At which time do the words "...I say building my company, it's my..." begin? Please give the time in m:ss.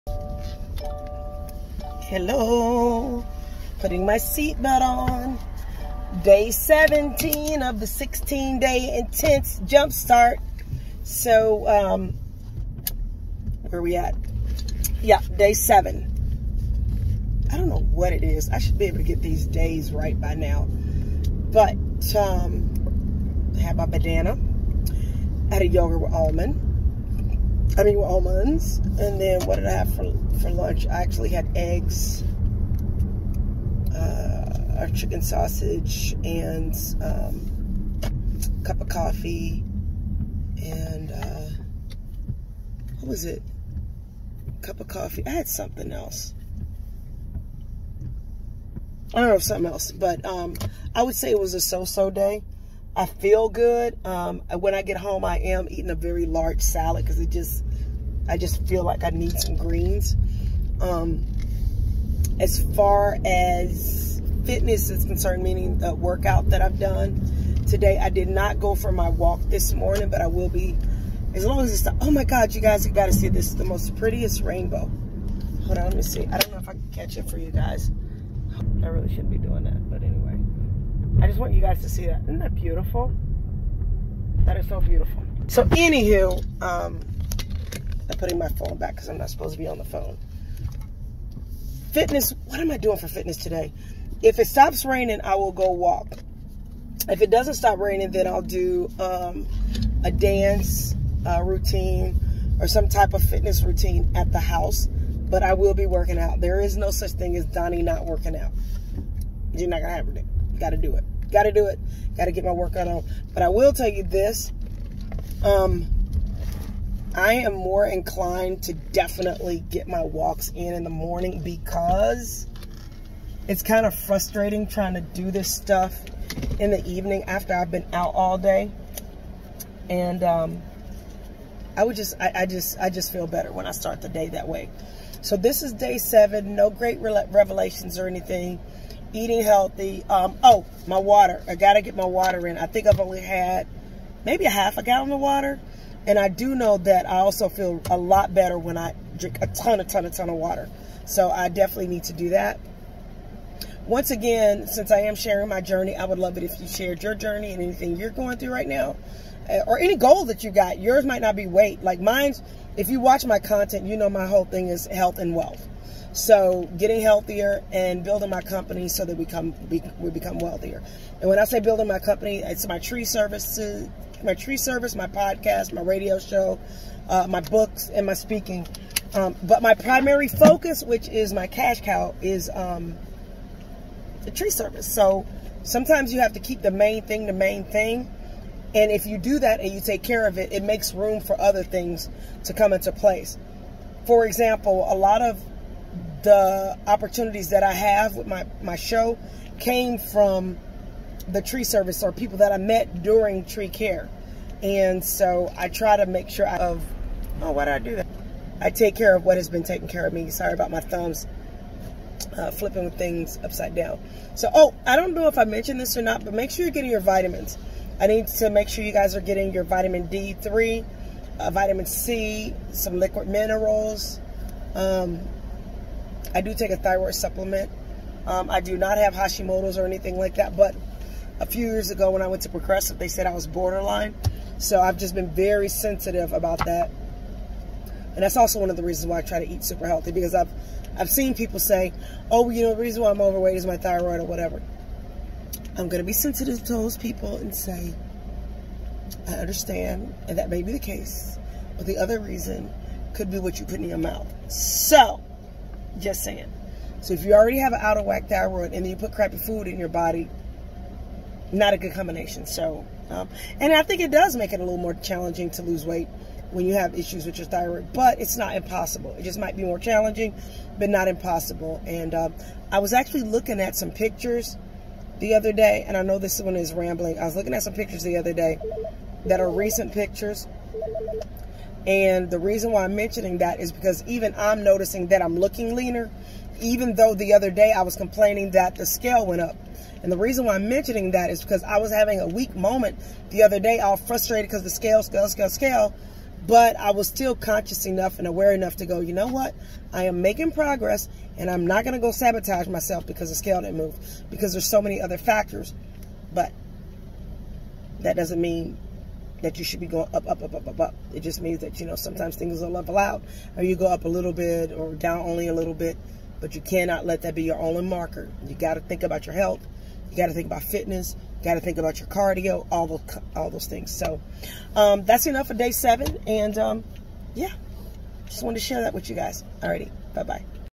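2:51.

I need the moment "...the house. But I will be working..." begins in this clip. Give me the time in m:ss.
1:44.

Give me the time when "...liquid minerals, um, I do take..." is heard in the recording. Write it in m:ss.
3:42.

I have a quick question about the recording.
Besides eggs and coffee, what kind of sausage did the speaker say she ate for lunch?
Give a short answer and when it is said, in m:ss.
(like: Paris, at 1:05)
chicken sausage, at 0:34.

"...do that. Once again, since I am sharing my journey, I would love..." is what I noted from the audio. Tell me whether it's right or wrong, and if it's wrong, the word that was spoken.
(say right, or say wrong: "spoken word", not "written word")
right.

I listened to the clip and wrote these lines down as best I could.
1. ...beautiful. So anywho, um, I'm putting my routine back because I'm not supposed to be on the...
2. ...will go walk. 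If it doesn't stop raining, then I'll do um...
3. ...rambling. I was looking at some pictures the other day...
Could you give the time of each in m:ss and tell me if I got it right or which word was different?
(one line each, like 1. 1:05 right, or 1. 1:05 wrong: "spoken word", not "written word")
1. 1:24 wrong: "phone", not "routine"
2. 1:35 right
3. 4:36 right.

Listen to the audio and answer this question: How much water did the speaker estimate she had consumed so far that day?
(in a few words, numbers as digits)
half a gallon.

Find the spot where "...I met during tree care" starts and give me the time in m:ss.
3:22.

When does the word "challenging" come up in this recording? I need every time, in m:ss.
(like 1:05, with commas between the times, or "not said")
4:24, 4:29.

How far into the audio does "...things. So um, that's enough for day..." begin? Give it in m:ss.
5:23.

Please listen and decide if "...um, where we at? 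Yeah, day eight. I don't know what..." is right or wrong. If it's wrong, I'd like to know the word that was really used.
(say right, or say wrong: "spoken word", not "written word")
wrong: "seven", not "eight".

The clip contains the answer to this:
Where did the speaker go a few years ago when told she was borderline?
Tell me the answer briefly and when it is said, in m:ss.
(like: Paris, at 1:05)
Progressive, at 3:52.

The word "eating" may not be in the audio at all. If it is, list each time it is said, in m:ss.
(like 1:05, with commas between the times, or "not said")
0:55, 2:19.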